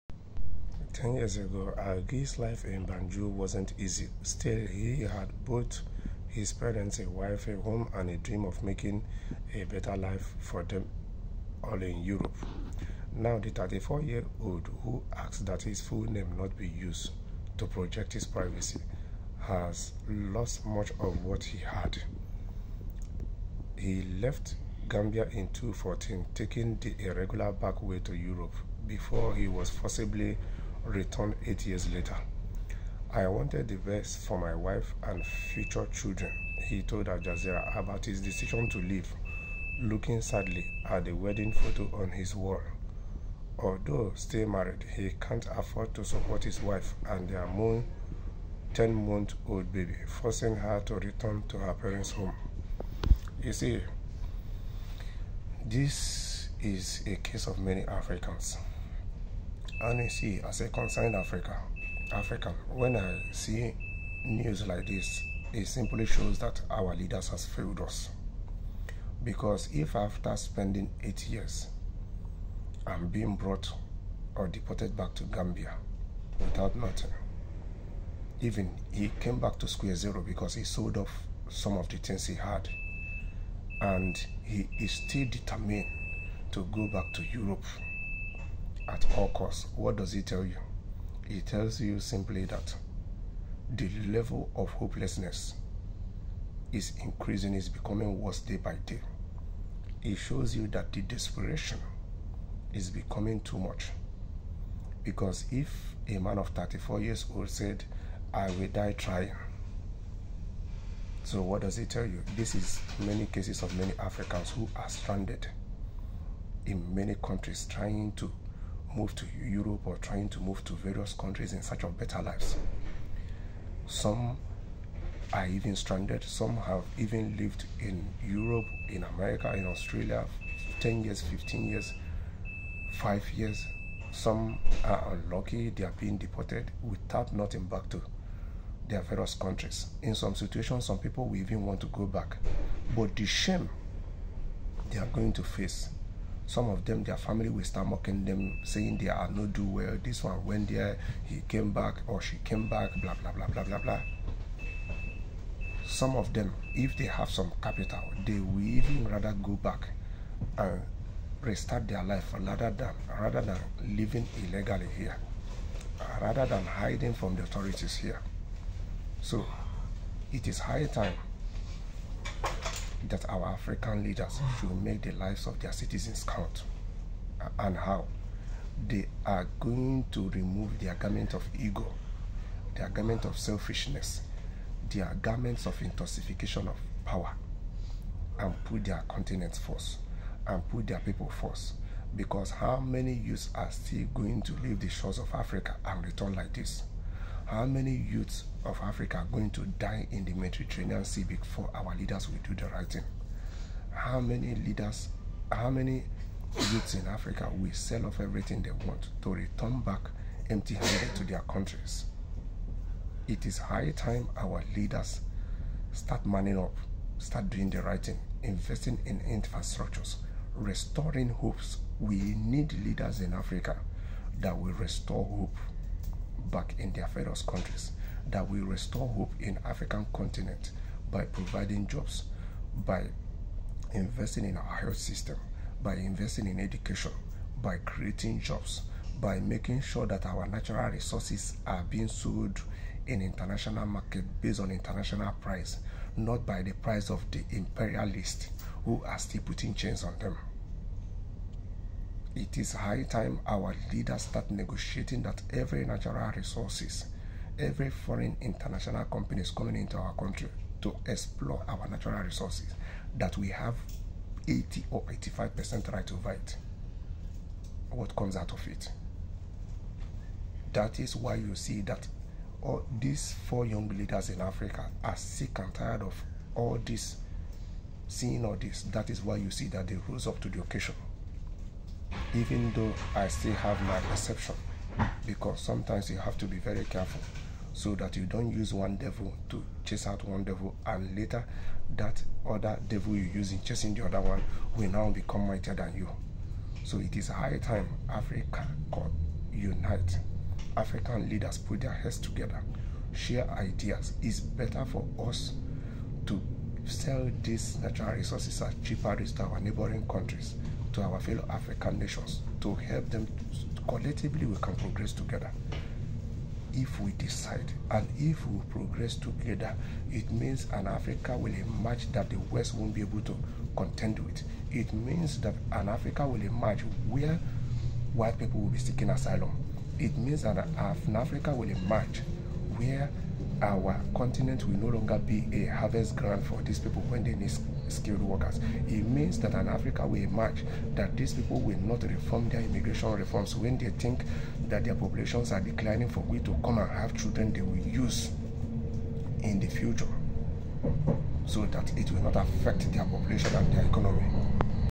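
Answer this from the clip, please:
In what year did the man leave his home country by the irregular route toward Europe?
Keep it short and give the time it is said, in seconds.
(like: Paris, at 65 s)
2014, at 25 s.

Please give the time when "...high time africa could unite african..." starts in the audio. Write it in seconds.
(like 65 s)
297 s.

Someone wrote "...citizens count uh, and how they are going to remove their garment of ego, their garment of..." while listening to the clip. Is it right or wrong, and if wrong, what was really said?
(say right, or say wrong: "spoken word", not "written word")
right.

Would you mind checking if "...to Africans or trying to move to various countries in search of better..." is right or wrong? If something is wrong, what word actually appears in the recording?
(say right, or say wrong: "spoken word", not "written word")
wrong: "Europe", not "Africans".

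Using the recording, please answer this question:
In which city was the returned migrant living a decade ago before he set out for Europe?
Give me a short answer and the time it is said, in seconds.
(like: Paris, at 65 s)
Banjul, at 2 s.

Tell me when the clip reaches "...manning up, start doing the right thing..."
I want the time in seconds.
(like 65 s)
216 s.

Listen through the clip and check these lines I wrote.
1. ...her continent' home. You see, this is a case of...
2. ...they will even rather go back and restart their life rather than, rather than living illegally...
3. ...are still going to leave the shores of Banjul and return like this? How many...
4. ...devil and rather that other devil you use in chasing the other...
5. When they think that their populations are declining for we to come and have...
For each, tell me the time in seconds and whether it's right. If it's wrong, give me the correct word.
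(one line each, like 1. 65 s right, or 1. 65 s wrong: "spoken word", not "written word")
1. 51 s wrong: "parents", not "continent"
2. 158 s right
3. 193 s wrong: "Africa", not "Banjul"
4. 290 s wrong: "later", not "rather"
5. 343 s right.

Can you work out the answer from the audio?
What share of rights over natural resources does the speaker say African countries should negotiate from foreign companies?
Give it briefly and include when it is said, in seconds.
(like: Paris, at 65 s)
80 or 85%, at 264 s.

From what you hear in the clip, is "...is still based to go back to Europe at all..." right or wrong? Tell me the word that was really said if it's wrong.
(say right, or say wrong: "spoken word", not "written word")
wrong: "determined", not "based".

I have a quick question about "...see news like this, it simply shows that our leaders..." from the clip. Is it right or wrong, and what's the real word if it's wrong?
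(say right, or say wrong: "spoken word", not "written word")
right.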